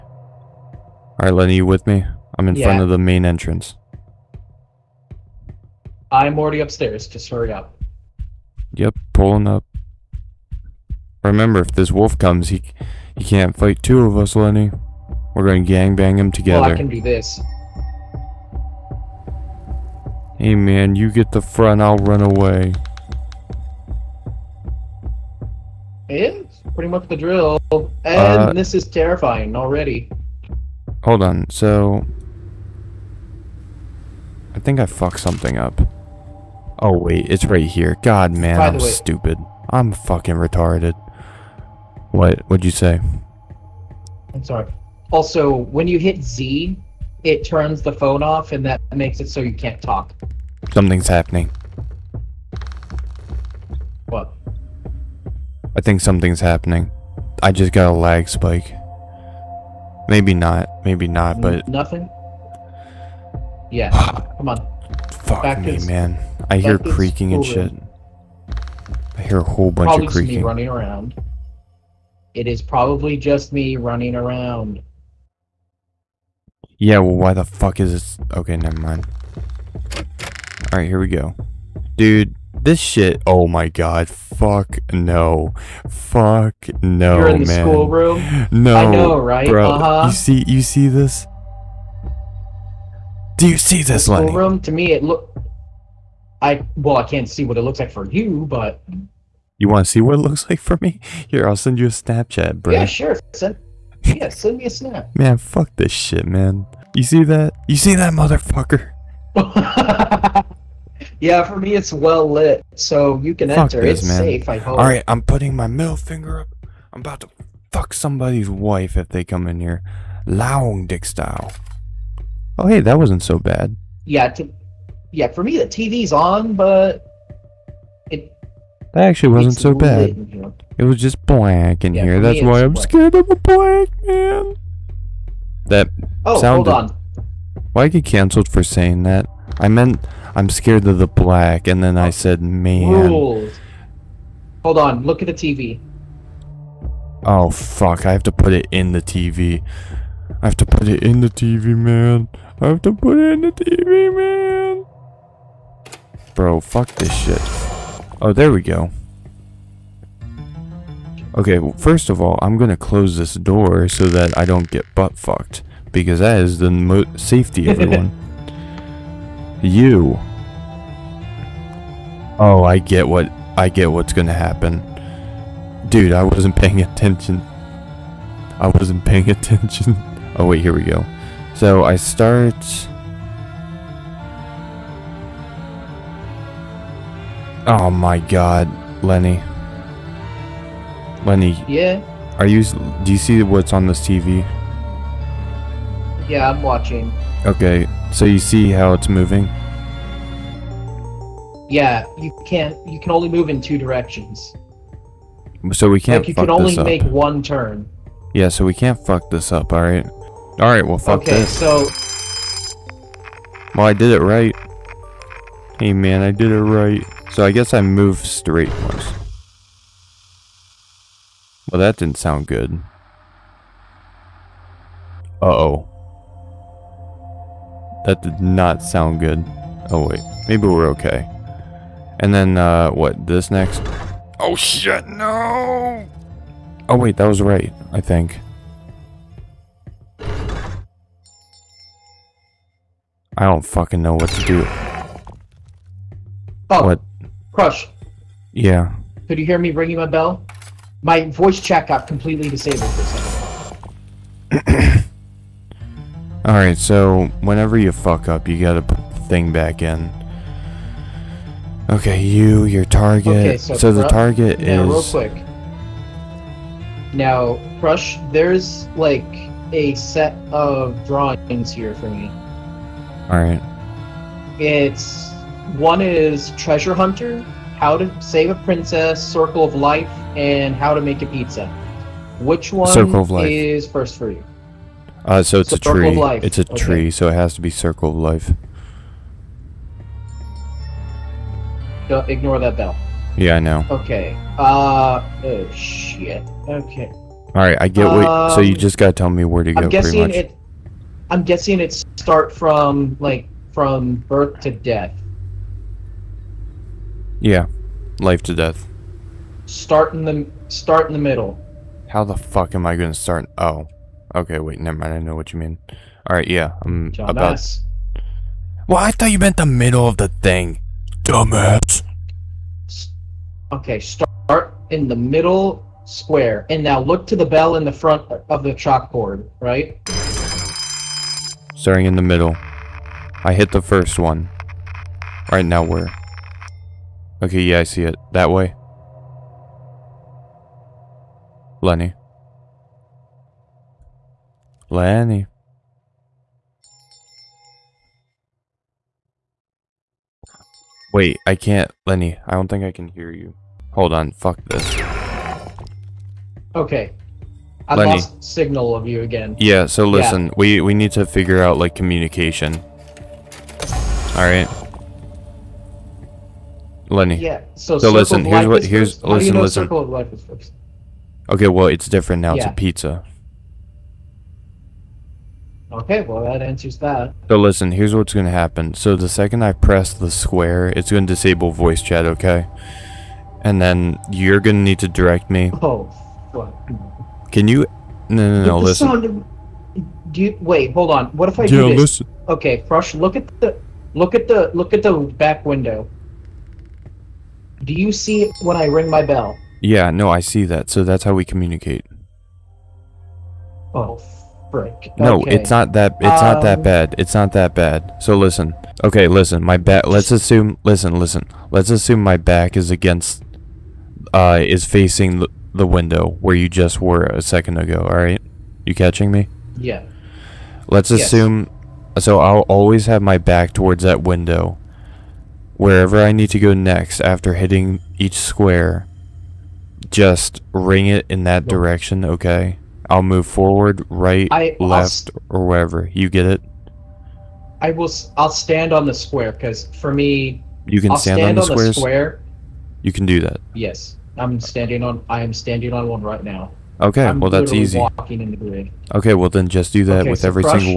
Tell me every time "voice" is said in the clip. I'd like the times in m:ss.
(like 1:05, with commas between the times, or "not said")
4:11, 6:21.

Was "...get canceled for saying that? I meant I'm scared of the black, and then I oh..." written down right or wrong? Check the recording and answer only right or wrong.
right.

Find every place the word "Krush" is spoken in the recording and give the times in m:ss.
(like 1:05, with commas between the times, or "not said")
6:32.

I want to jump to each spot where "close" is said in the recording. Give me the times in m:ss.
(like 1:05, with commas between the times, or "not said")
2:42.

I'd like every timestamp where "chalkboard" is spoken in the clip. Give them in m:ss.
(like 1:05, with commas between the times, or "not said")
5:28.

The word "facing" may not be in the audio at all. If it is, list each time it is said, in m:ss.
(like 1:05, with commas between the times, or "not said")
6:54.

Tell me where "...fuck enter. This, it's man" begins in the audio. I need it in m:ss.
1:53.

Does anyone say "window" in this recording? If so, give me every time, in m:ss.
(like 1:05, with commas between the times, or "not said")
6:35, 6:55, 7:04.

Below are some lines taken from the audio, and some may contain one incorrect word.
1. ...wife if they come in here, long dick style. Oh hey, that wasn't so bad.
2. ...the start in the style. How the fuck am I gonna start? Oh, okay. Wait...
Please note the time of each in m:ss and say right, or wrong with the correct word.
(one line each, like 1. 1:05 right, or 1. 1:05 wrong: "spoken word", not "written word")
1. 1:58 right
2. 5:10 wrong: "middle", not "style".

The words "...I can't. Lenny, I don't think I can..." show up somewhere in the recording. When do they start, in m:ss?
5:51.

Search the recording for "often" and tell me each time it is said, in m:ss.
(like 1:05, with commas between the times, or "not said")
not said.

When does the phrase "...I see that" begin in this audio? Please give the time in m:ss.
6:40.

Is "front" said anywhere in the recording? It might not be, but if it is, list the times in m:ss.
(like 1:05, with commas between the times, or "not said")
0:02, 0:21, 5:27.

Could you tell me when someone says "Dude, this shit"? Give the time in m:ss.
1:21.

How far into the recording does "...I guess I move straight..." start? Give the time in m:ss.
3:37.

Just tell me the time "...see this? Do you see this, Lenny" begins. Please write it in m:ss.
1:30.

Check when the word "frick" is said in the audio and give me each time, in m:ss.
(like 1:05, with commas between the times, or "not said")
6:44.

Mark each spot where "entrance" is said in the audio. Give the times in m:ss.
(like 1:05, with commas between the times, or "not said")
0:03.